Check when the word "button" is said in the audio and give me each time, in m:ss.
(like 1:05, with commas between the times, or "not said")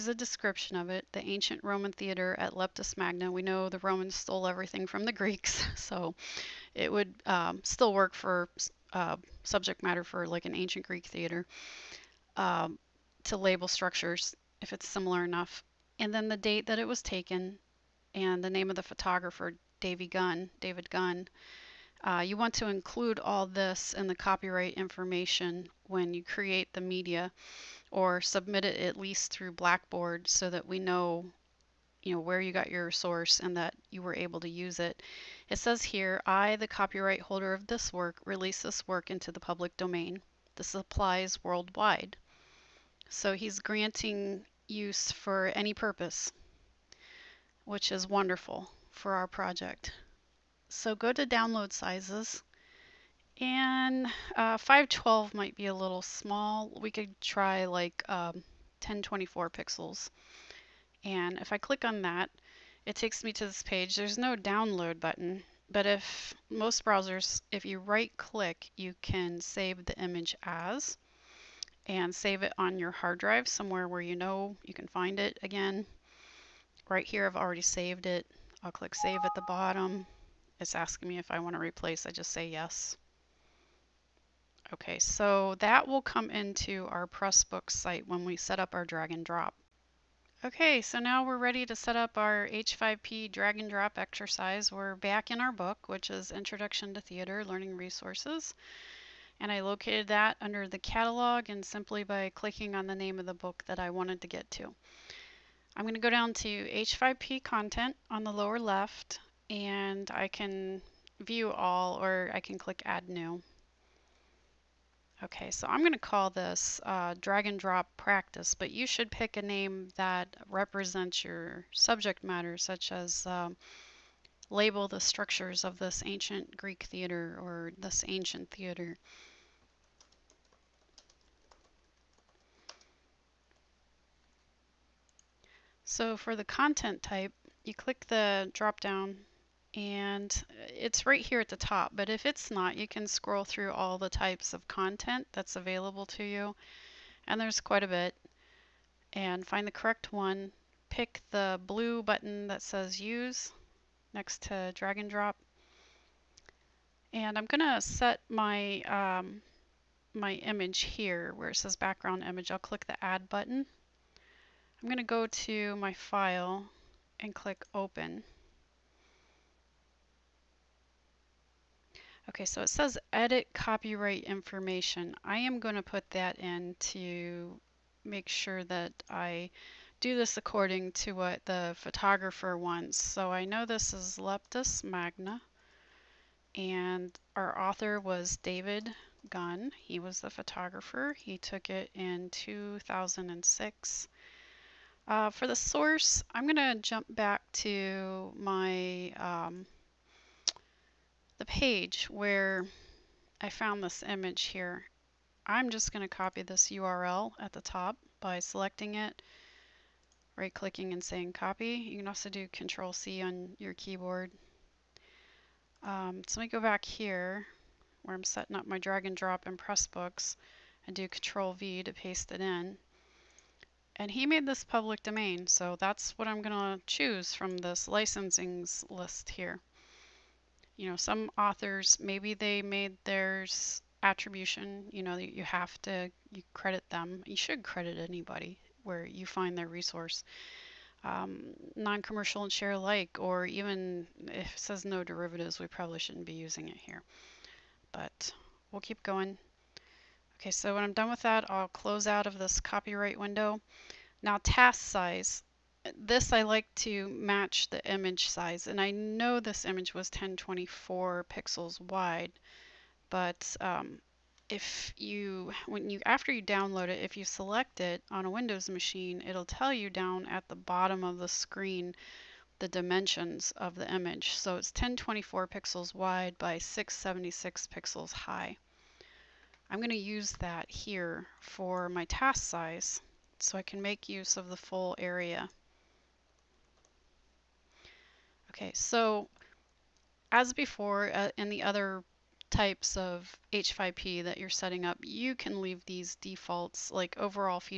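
1:04, 2:32, 2:43.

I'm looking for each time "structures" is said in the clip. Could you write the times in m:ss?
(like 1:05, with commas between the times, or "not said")
0:13, 2:05.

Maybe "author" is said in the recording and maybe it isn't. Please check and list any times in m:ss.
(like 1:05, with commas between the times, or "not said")
3:07, 3:51.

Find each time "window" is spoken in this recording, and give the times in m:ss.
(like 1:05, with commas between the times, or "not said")
4:13, 4:28.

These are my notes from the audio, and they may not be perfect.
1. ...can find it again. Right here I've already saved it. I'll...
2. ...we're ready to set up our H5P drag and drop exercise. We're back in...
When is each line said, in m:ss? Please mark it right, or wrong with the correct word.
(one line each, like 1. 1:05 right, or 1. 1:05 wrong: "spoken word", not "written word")
1. 1:14 right
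2. 1:31 right.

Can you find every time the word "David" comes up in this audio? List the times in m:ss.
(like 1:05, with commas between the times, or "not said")
0:20, 3:08.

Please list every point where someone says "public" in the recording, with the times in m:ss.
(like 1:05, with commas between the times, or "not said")
0:39, 3:44.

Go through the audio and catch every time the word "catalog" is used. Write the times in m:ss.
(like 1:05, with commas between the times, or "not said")
1:40.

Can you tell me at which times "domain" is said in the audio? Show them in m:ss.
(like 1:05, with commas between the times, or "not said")
0:39, 3:45.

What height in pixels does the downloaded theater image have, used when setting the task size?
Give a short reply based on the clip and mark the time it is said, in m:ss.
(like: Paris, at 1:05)
676, at 4:36.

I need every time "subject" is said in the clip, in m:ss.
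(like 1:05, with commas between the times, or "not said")
0:09, 2:01.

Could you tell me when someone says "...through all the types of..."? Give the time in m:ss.
2:23.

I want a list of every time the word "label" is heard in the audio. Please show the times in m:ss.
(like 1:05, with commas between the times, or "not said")
0:13, 2:04.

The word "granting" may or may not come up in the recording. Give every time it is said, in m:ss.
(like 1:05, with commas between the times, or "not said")
0:43.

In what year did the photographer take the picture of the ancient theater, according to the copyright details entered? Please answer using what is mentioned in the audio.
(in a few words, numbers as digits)
2006.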